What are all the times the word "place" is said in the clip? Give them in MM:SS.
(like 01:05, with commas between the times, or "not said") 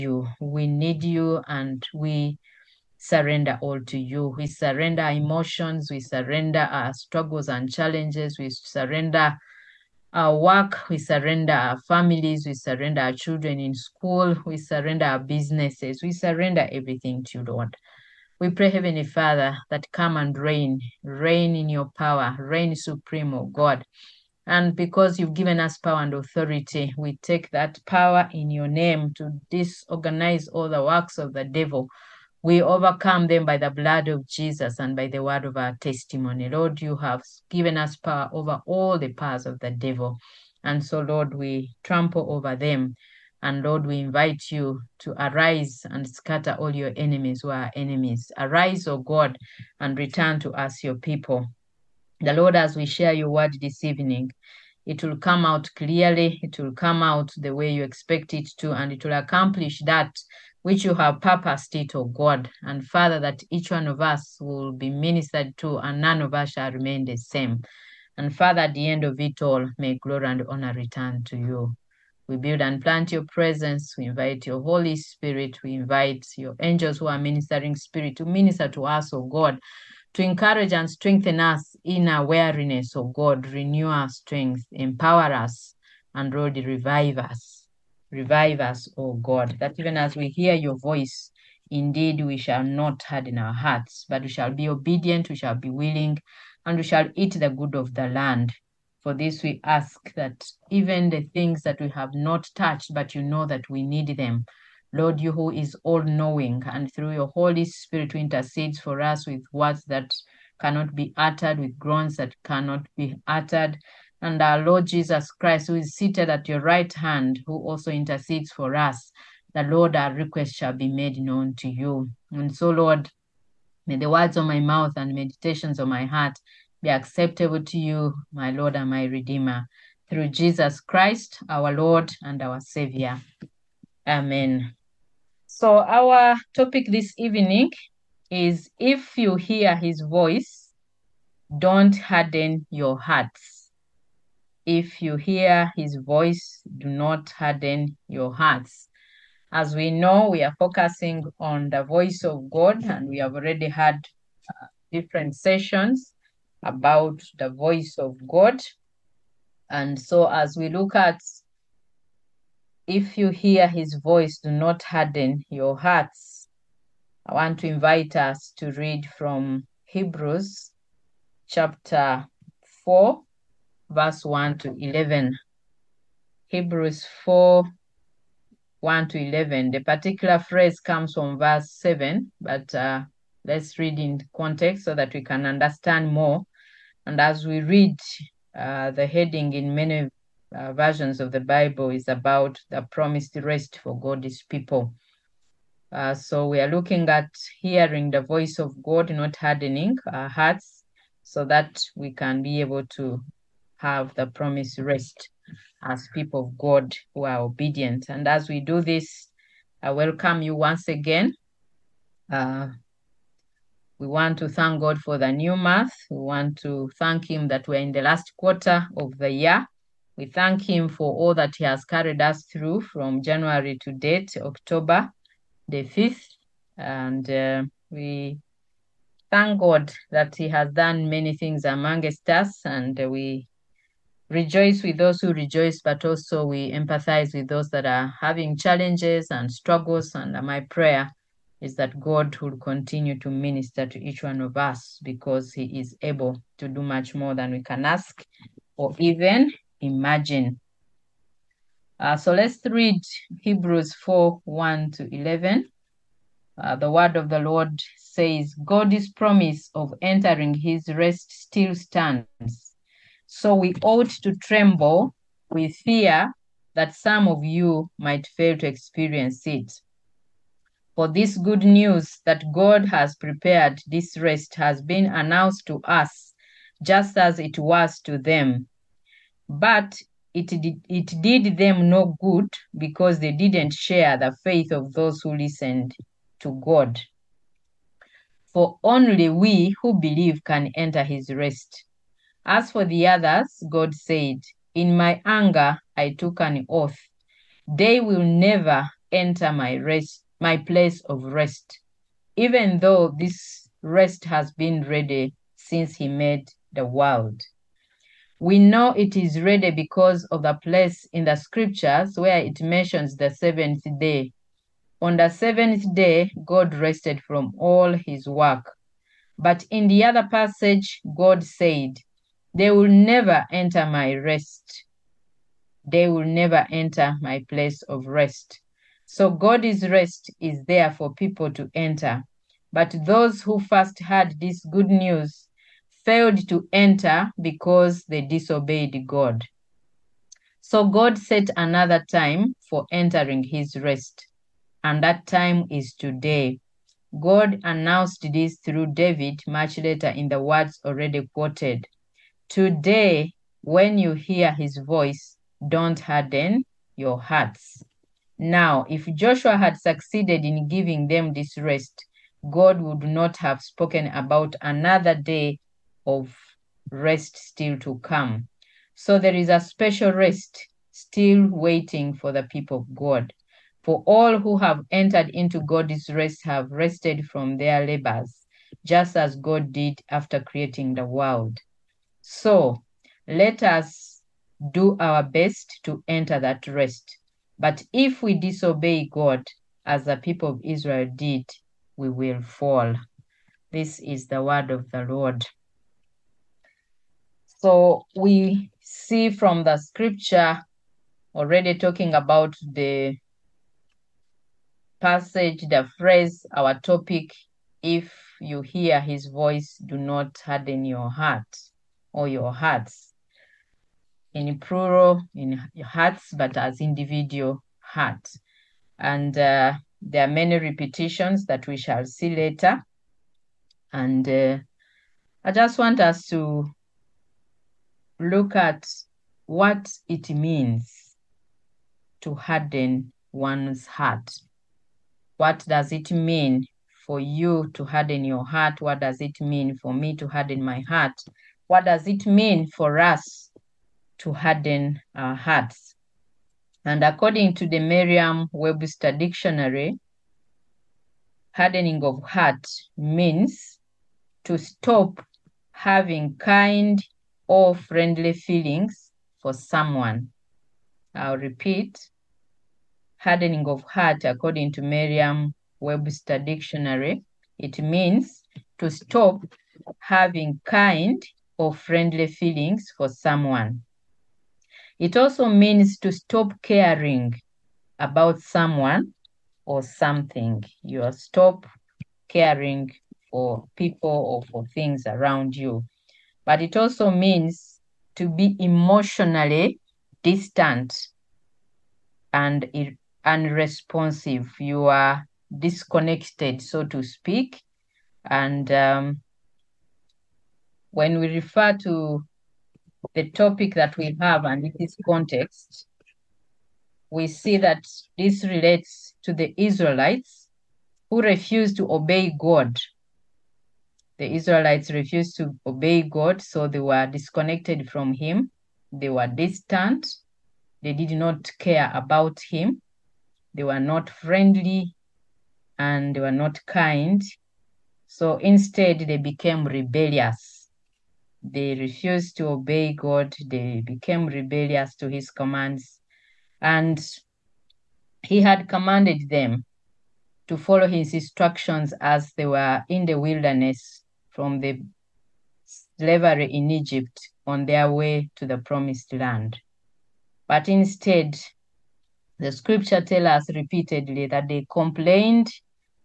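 05:00, 05:10, 05:27.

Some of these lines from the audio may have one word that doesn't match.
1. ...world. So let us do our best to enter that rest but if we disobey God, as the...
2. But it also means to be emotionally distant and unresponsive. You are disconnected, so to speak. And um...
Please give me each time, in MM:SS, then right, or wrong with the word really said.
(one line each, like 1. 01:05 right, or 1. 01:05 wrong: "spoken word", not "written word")
1. 06:21 right
2. 08:06 right.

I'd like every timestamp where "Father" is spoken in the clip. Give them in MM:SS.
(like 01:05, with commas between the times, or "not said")
00:19, 01:02, 01:08.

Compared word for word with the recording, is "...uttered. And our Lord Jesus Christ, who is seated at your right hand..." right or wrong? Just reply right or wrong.
right.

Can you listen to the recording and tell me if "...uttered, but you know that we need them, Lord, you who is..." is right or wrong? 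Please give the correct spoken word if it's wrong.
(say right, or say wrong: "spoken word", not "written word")
wrong: "touched", not "uttered".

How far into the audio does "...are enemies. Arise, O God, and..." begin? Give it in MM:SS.
00:47.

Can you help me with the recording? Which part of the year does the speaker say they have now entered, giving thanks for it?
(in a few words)
Last quarter.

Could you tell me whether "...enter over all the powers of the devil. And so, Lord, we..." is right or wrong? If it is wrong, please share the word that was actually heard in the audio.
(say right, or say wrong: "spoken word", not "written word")
wrong: "power", not "enter".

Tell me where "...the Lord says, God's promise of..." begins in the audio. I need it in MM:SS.
04:17.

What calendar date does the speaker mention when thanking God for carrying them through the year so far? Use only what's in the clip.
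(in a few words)
October 5.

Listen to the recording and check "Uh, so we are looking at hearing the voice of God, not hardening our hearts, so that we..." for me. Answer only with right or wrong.
right.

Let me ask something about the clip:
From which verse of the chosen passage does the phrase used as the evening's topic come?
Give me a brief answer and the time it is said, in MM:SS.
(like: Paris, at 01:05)
Verse 7, at 03:01.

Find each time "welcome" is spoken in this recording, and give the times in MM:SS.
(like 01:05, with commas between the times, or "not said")
03:29.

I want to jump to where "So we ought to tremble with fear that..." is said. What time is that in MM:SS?
04:23.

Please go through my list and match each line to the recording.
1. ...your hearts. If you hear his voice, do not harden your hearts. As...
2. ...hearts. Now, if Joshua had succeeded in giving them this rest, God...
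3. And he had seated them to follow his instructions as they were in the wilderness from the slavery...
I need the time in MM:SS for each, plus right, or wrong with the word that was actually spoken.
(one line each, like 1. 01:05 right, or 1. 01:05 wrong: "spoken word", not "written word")
1. 02:22 right
2. 05:57 right
3. 08:56 wrong: "commanded", not "seated".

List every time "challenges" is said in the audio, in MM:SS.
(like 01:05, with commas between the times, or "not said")
00:07, 03:58.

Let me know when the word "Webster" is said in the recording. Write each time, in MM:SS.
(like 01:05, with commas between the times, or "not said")
07:28, 07:45.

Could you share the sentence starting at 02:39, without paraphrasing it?
And so, as we look at if you hear his voice, do not harden your hearts.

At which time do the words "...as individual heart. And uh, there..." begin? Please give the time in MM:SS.
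06:56.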